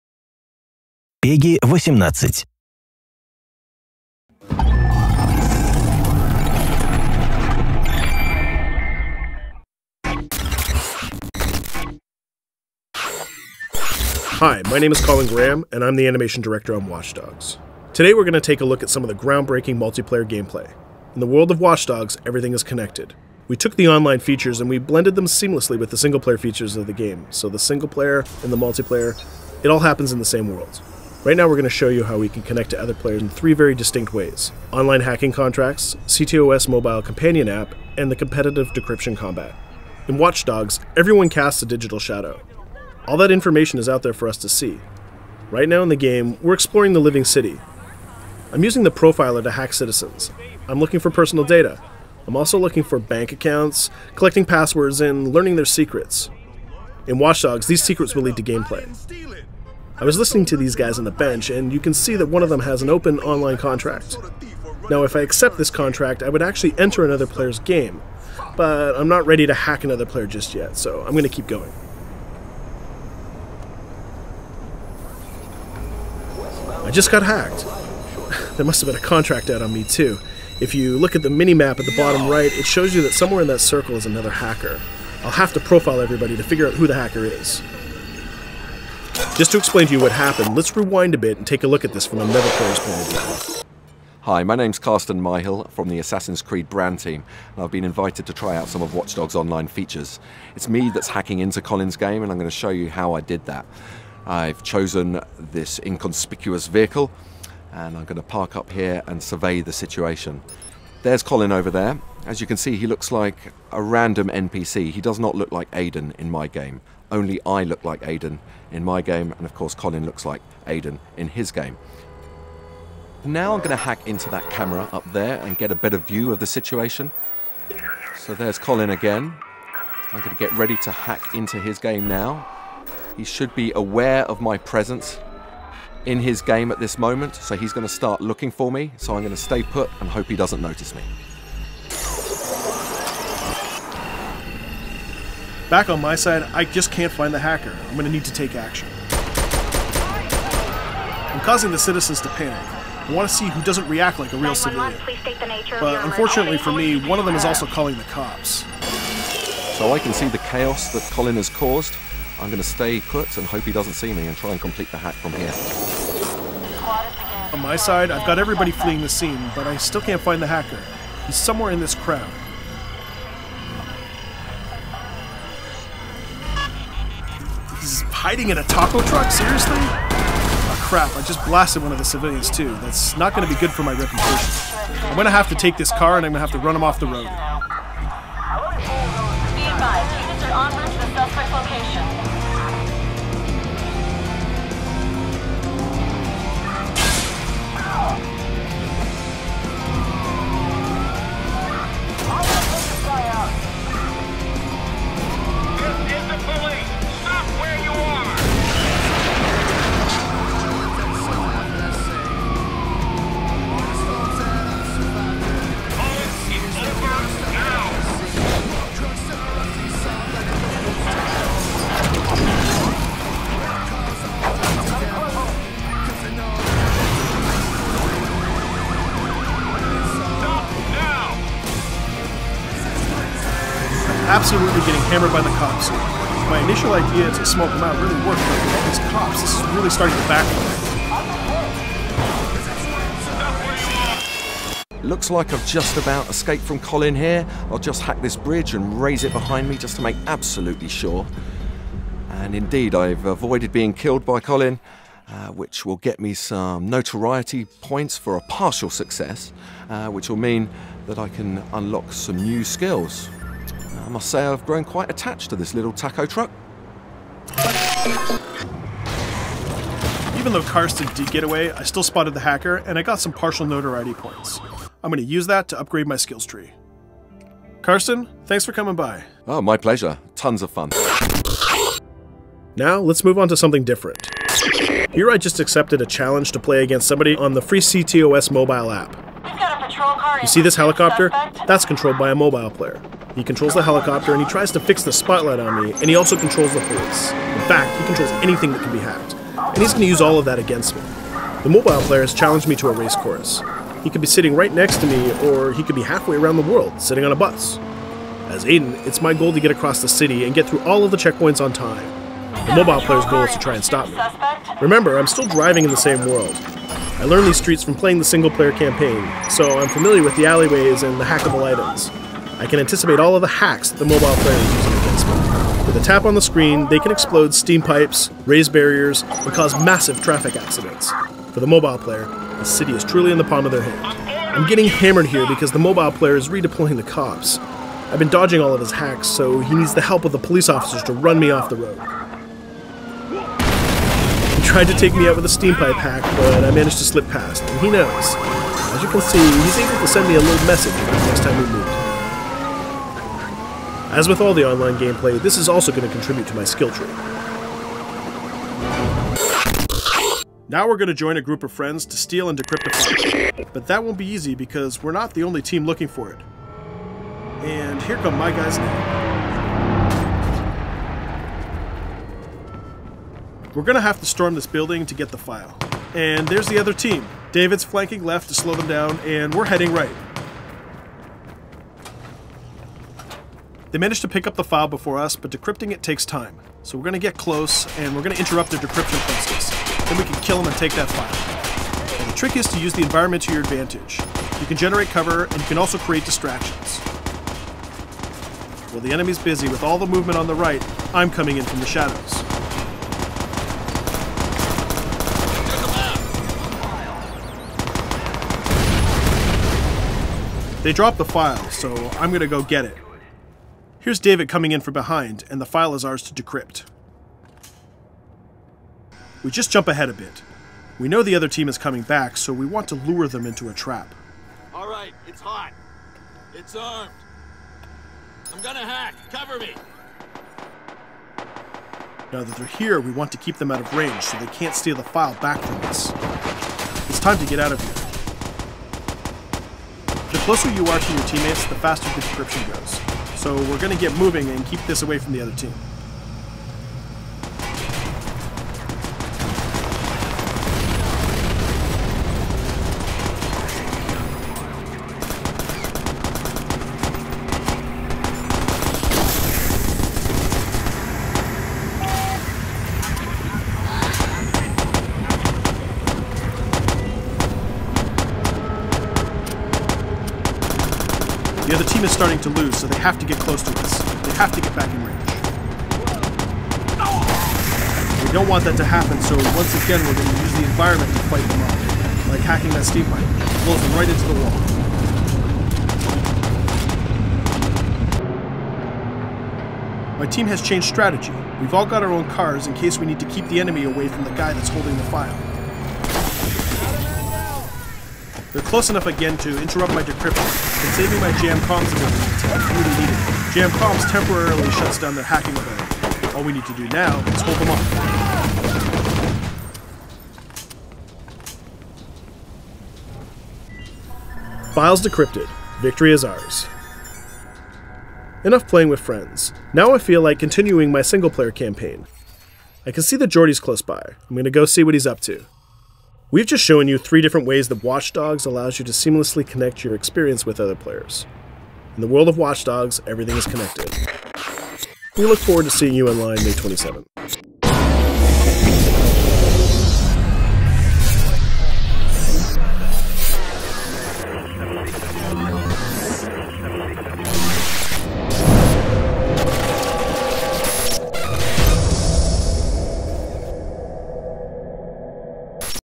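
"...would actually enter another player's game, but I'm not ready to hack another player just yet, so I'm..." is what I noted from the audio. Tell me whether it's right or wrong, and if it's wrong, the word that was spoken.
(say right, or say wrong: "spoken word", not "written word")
right.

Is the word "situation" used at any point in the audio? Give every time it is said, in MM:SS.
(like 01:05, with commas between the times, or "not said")
01:49, 02:06.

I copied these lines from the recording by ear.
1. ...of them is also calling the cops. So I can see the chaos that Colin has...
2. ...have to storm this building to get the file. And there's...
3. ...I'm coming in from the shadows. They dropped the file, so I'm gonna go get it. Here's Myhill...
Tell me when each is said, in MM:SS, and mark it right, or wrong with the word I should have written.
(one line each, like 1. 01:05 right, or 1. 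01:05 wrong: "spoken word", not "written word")
1. 02:37 right
2. 06:14 right
3. 06:41 wrong: "David", not "Myhill".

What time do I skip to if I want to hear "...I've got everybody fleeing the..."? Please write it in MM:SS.
02:48.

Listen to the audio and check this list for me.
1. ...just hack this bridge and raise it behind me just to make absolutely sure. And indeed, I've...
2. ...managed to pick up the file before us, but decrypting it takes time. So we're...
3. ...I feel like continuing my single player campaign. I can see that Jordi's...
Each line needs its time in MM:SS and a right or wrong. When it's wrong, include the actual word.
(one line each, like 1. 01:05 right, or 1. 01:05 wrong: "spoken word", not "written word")
1. 04:07 right
2. 06:23 right
3. 08:39 right.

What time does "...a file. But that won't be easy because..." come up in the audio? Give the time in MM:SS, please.
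06:02.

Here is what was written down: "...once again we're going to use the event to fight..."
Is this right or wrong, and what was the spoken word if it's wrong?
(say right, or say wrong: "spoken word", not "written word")
wrong: "environment", not "event".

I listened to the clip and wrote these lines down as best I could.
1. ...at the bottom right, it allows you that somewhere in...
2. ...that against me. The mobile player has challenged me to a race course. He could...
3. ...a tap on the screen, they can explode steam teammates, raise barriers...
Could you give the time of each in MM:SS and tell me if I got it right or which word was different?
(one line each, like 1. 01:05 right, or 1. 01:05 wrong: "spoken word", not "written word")
1. 01:21 wrong: "shows", not "allows"
2. 05:00 right
3. 05:25 wrong: "pipes", not "teammates".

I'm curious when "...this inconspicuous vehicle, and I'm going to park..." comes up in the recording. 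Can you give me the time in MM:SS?
01:45.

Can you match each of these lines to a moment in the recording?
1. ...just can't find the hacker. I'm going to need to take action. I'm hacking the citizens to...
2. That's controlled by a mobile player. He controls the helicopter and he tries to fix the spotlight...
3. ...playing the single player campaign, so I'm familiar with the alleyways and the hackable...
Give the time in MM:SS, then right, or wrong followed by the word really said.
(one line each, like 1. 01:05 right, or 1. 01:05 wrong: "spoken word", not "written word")
1. 02:26 wrong: "causing", not "hacking"
2. 04:51 right
3. 05:17 right.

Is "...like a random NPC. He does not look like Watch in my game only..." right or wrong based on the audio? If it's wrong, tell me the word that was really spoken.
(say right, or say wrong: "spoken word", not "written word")
wrong: "Aiden", not "Watch".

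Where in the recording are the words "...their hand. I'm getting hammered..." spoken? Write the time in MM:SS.
05:33.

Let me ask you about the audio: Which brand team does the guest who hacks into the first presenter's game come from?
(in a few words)
Assassin's Creed.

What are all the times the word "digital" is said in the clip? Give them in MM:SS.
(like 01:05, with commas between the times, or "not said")
00:41.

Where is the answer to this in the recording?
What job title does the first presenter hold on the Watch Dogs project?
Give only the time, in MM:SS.
00:16.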